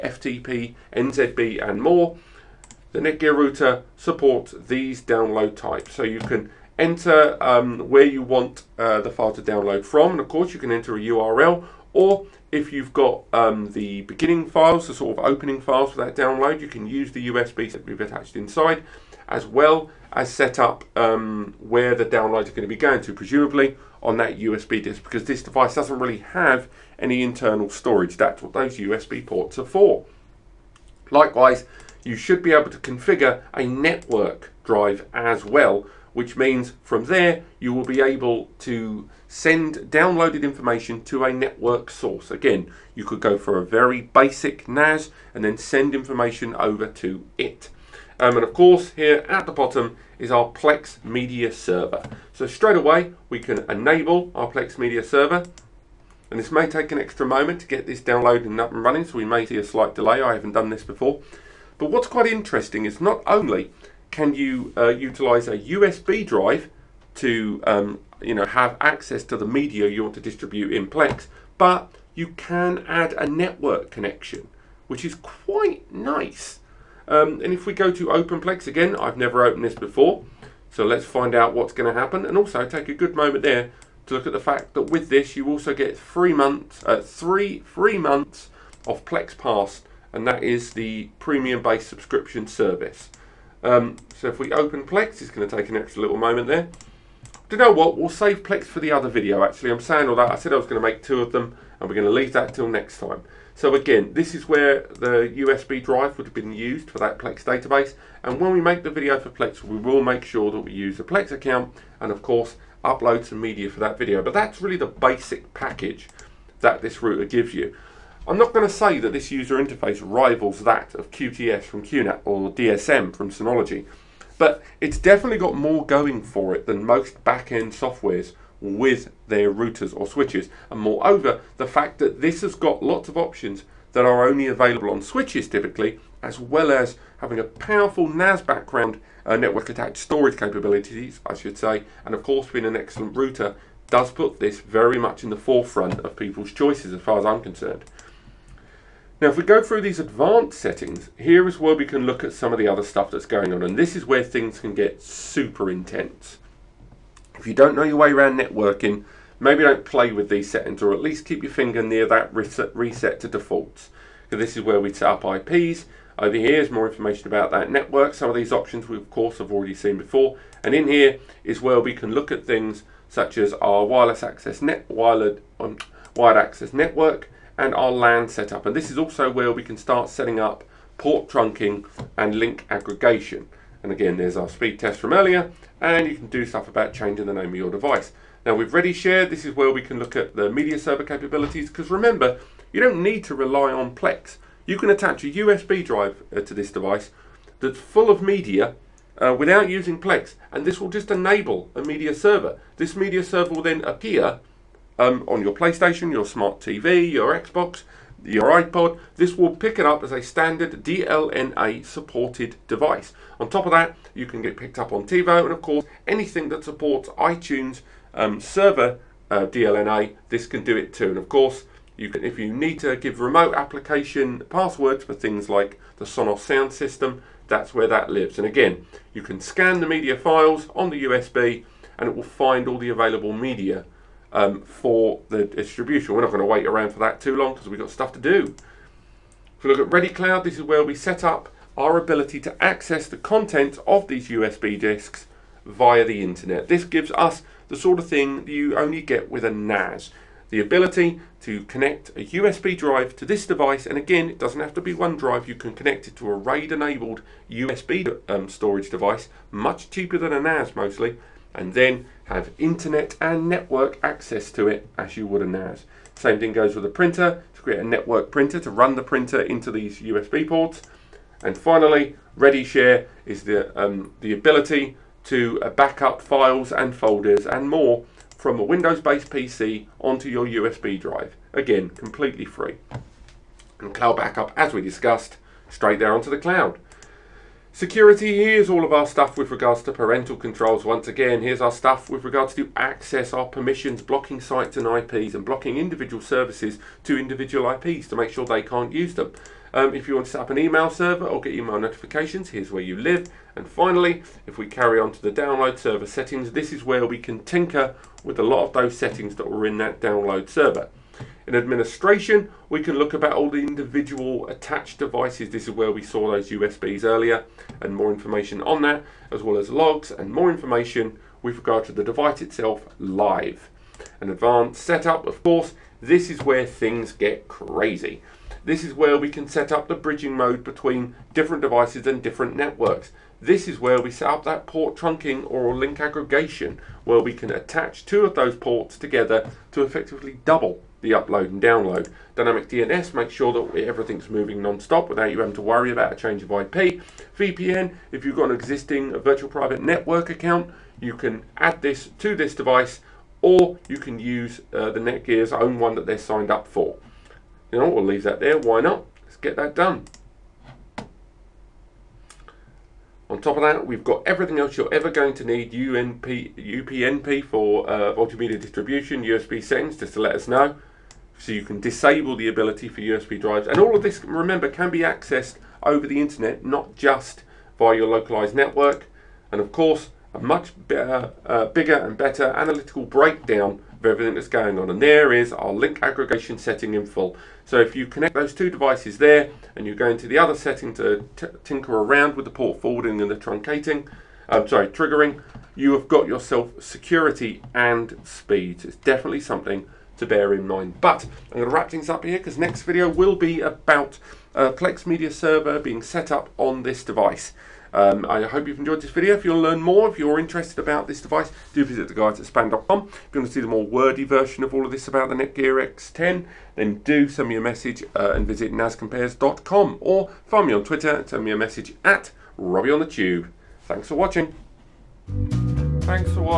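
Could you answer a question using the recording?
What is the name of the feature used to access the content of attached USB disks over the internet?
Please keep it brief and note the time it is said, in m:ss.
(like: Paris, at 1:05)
Ready Cloud, at 3:59.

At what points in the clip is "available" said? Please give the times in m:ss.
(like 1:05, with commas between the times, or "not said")
2:14, 3:52.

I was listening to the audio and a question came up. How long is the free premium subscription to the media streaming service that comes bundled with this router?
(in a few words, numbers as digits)
3 months.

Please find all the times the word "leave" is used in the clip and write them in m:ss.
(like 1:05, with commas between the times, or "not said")
1:42, 5:58.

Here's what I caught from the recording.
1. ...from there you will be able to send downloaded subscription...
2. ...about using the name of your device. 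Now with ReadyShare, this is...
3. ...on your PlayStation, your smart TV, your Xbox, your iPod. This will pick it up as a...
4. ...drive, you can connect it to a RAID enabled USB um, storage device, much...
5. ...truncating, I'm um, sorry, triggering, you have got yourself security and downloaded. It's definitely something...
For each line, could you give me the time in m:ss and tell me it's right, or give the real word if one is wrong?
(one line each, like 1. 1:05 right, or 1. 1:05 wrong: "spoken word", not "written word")
1. 0:36 wrong: "information", not "subscription"
2. 3:06 wrong: "changing", not "using"
3. 3:25 right
4. 4:15 right
5. 6:33 wrong: "speed", not "downloaded".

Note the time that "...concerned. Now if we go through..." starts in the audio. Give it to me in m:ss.
2:27.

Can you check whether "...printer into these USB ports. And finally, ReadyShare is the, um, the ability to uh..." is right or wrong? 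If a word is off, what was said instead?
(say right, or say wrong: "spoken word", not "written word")
right.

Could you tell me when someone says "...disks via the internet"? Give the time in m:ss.
4:04.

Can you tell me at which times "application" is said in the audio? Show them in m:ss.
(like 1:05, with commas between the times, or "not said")
3:43.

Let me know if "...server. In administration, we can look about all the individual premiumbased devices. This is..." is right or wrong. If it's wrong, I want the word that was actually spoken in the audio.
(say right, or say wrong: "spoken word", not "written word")
wrong: "attached", not "premiumbased".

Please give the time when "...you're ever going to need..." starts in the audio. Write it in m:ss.
6:04.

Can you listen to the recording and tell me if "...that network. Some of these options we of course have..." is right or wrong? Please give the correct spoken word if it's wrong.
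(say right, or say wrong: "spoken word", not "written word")
right.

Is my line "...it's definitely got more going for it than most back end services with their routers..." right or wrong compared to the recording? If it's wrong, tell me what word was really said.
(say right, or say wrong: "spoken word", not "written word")
wrong: "softwares", not "services".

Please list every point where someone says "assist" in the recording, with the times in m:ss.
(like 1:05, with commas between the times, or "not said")
not said.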